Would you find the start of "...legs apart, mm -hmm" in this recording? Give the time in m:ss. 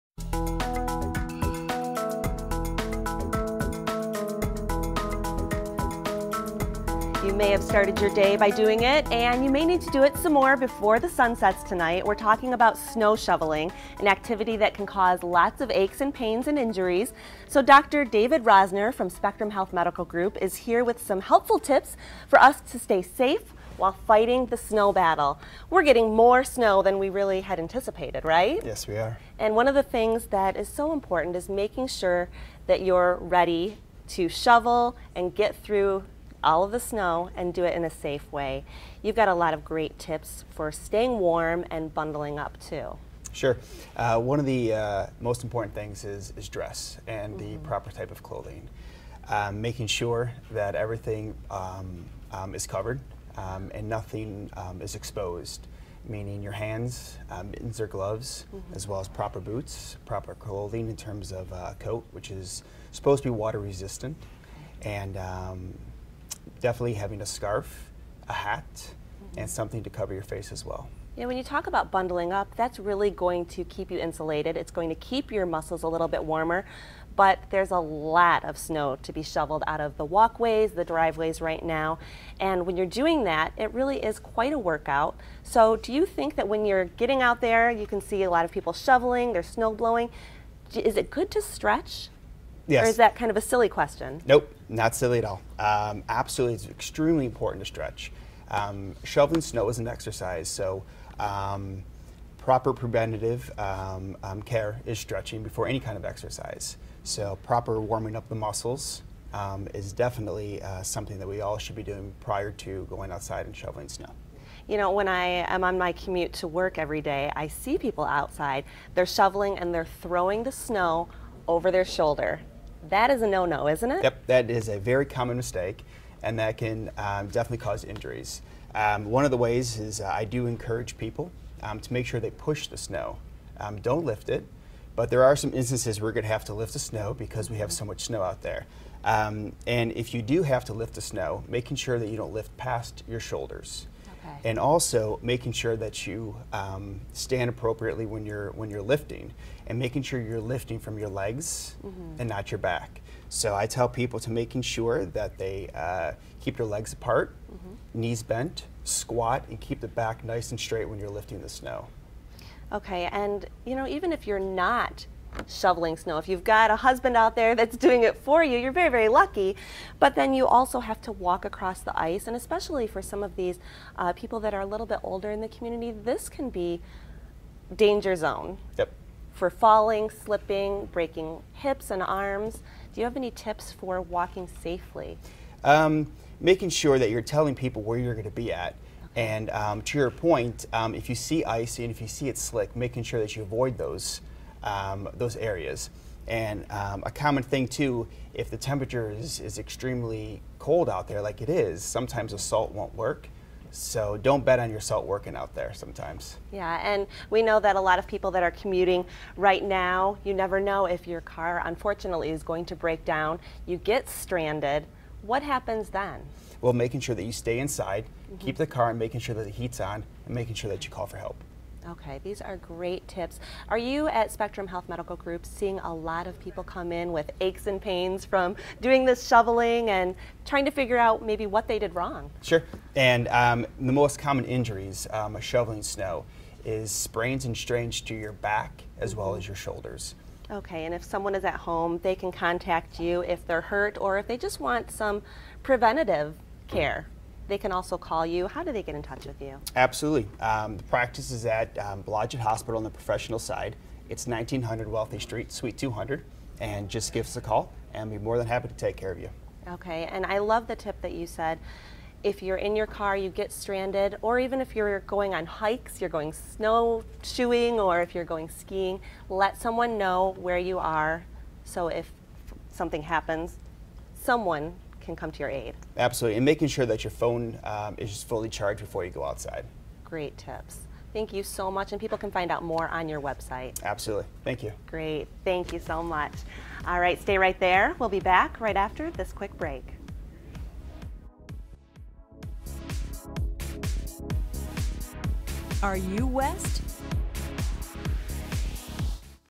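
2:36.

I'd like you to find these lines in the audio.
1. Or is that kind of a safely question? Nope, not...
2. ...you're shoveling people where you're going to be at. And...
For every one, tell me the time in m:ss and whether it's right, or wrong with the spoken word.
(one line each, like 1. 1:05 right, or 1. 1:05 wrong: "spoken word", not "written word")
1. 1:32 wrong: "silly", not "safely"
2. 3:07 wrong: "telling", not "shoveling".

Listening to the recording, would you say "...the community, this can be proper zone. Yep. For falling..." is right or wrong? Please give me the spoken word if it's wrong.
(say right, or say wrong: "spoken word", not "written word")
wrong: "danger", not "proper".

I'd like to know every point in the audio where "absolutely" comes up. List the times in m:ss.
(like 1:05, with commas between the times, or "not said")
1:36, 4:09, 4:35, 4:43.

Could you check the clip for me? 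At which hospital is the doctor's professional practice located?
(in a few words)
Blodgett Hospital.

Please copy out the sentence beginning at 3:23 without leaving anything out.
So don't bet on your salt working out there sometimes.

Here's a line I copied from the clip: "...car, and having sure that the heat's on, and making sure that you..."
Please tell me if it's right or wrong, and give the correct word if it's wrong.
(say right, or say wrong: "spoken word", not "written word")
wrong: "making", not "having".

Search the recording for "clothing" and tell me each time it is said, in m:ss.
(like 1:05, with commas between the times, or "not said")
0:48, 1:00.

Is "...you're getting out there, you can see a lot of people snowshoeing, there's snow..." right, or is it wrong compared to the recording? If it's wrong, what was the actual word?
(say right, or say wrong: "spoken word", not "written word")
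wrong: "shoveling", not "snowshoeing".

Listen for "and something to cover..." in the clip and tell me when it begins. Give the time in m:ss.
1:09.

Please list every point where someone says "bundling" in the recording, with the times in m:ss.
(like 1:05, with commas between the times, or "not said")
0:41, 1:11.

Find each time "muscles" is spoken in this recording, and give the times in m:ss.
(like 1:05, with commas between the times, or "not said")
1:15, 1:48.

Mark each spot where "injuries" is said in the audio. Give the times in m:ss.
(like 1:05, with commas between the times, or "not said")
0:16, 2:07, 3:54.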